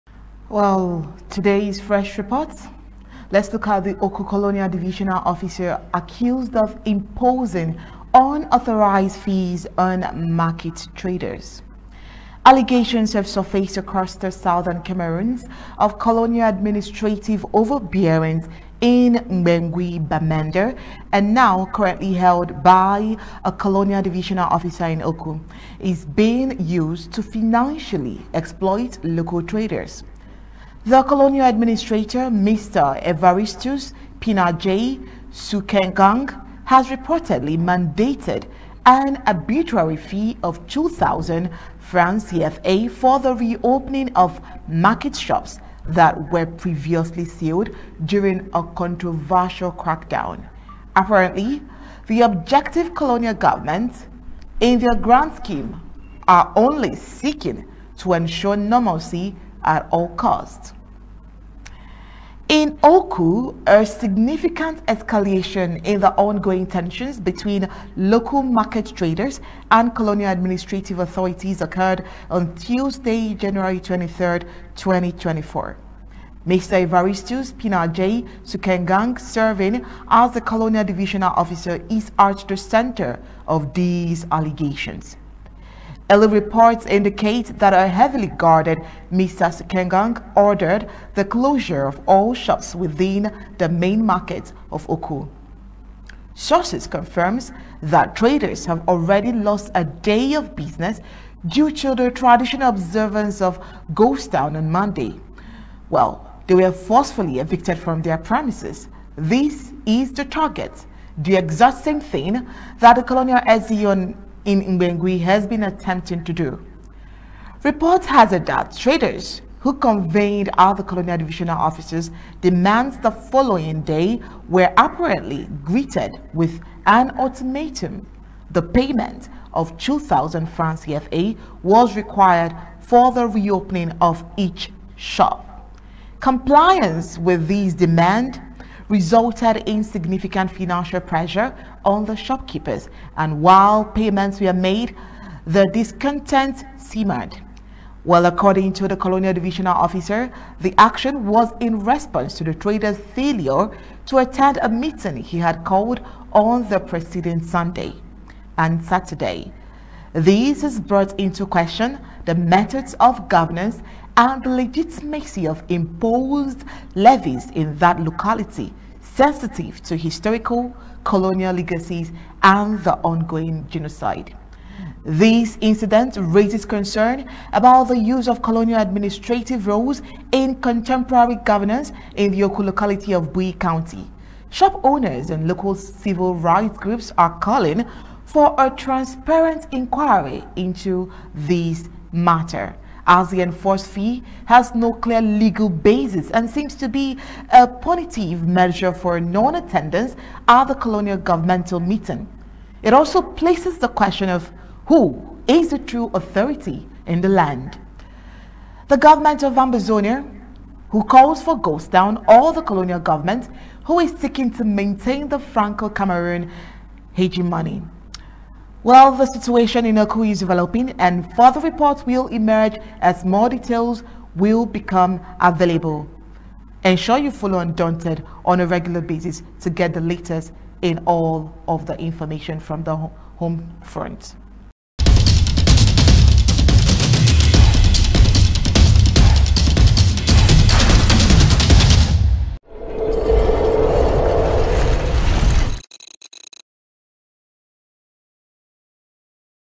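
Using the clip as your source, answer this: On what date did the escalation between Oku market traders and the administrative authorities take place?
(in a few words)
Tuesday, January 23, 2024.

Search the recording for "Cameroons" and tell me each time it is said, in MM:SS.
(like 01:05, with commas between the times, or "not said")
00:14, 03:35.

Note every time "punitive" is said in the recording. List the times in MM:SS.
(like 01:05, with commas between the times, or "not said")
03:17.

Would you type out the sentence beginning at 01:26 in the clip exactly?
Early reports indicate that a heavily guarded Mr.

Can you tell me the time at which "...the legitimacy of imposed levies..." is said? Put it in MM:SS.
02:44.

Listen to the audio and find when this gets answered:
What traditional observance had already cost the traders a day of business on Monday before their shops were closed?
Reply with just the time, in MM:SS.
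01:43.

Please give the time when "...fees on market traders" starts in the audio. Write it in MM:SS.
00:09.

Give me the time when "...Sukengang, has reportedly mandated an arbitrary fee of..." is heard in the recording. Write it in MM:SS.
00:35.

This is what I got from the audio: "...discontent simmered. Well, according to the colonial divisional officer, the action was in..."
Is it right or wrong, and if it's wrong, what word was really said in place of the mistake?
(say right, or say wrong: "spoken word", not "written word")
right.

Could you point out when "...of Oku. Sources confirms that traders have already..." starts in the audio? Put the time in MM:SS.
01:34.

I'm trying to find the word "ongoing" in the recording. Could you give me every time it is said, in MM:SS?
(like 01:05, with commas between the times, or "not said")
01:06, 02:52.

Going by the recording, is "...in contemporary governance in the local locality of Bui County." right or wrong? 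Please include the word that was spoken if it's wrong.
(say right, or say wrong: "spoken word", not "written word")
right.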